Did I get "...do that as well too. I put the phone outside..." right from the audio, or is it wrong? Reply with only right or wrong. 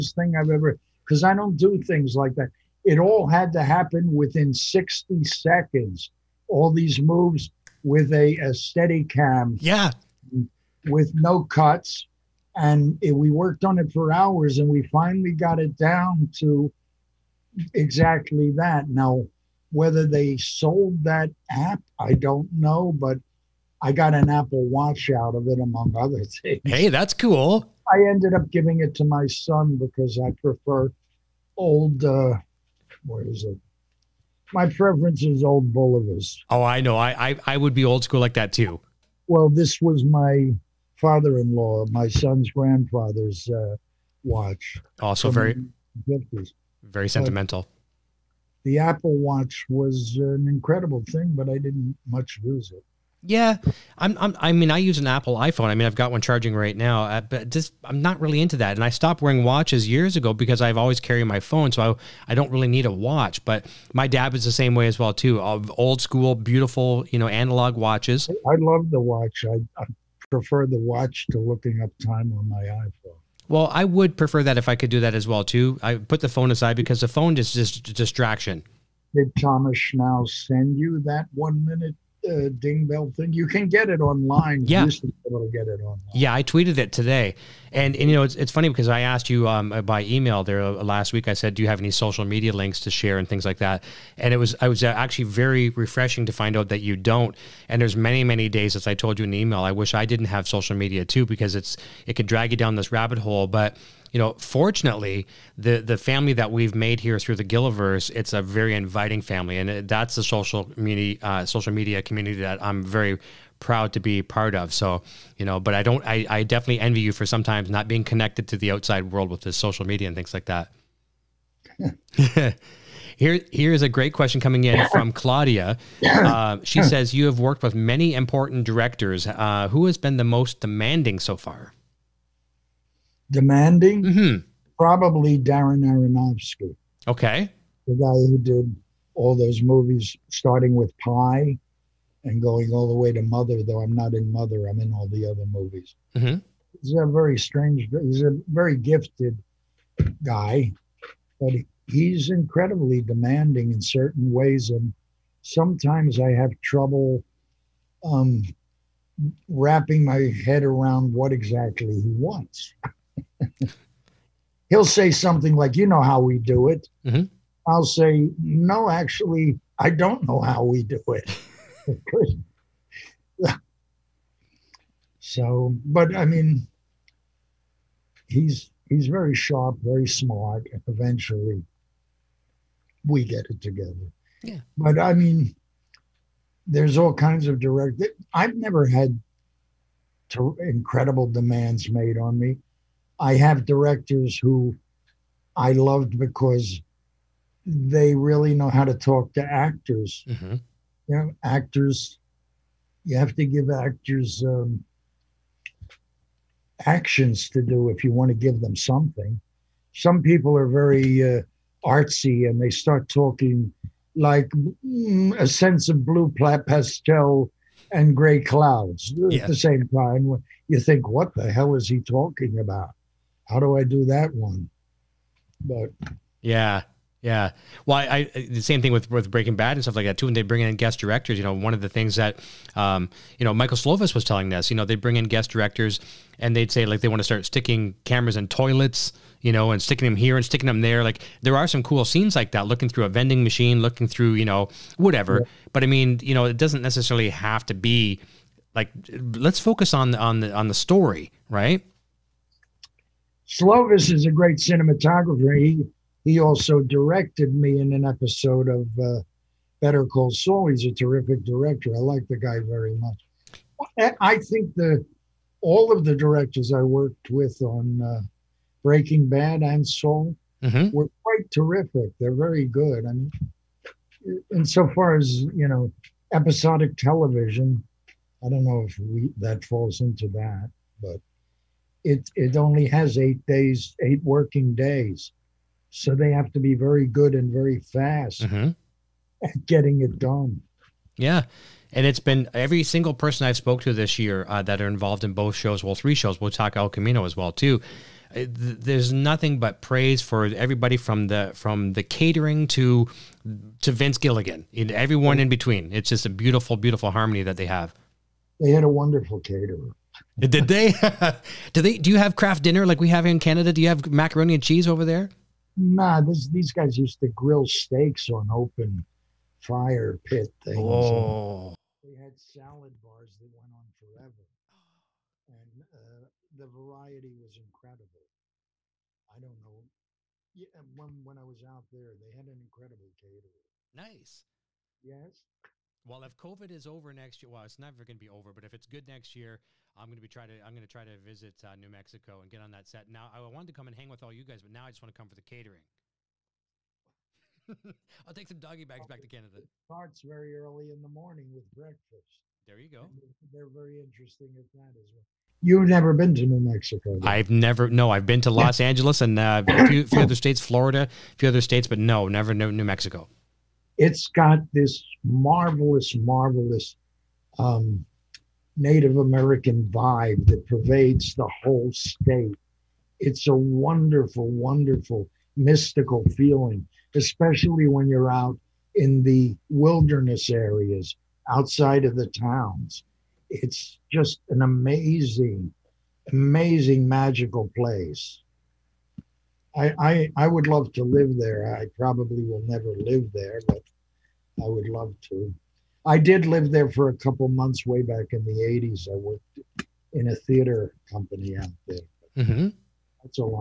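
wrong.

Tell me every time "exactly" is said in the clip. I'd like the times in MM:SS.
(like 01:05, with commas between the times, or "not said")
00:17, 02:41.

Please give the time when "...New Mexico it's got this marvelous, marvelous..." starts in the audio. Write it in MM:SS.
06:02.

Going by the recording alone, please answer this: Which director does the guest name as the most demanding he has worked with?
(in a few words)
Darren Aronofsky.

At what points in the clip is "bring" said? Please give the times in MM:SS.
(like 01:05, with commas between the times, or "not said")
03:50, 03:54.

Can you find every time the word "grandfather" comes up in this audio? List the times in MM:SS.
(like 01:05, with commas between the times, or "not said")
00:42.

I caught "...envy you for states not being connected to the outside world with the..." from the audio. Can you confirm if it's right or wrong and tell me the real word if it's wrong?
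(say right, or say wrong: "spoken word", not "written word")
wrong: "sometimes", not "states".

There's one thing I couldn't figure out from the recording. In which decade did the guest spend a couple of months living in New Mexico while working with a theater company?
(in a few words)
1980s.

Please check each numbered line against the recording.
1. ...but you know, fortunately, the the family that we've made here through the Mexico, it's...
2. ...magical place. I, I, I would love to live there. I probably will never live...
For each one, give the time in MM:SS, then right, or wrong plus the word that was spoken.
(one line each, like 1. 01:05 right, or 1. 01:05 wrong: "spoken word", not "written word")
1. 01:43 wrong: "Gilliverse", not "Mexico"
2. 06:27 right.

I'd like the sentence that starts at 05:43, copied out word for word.
Now, I wanted to come and hang with all you guys, but now I just want to come for the catering.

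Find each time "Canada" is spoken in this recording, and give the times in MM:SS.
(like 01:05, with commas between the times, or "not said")
05:13, 05:49.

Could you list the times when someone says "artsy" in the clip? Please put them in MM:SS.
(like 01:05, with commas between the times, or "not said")
03:31.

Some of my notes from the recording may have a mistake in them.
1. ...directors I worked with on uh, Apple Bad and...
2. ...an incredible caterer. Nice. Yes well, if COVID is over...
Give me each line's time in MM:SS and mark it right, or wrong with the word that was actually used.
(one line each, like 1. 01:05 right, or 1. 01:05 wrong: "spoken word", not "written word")
1. 04:26 wrong: "Breaking", not "Apple"
2. 05:32 right.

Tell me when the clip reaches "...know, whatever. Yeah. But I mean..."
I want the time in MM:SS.
04:04.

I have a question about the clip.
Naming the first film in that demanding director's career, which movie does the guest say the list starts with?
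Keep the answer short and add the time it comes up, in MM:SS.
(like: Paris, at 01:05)
Pi, at 02:21.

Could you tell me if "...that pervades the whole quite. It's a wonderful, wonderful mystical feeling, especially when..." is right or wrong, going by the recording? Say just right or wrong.
wrong.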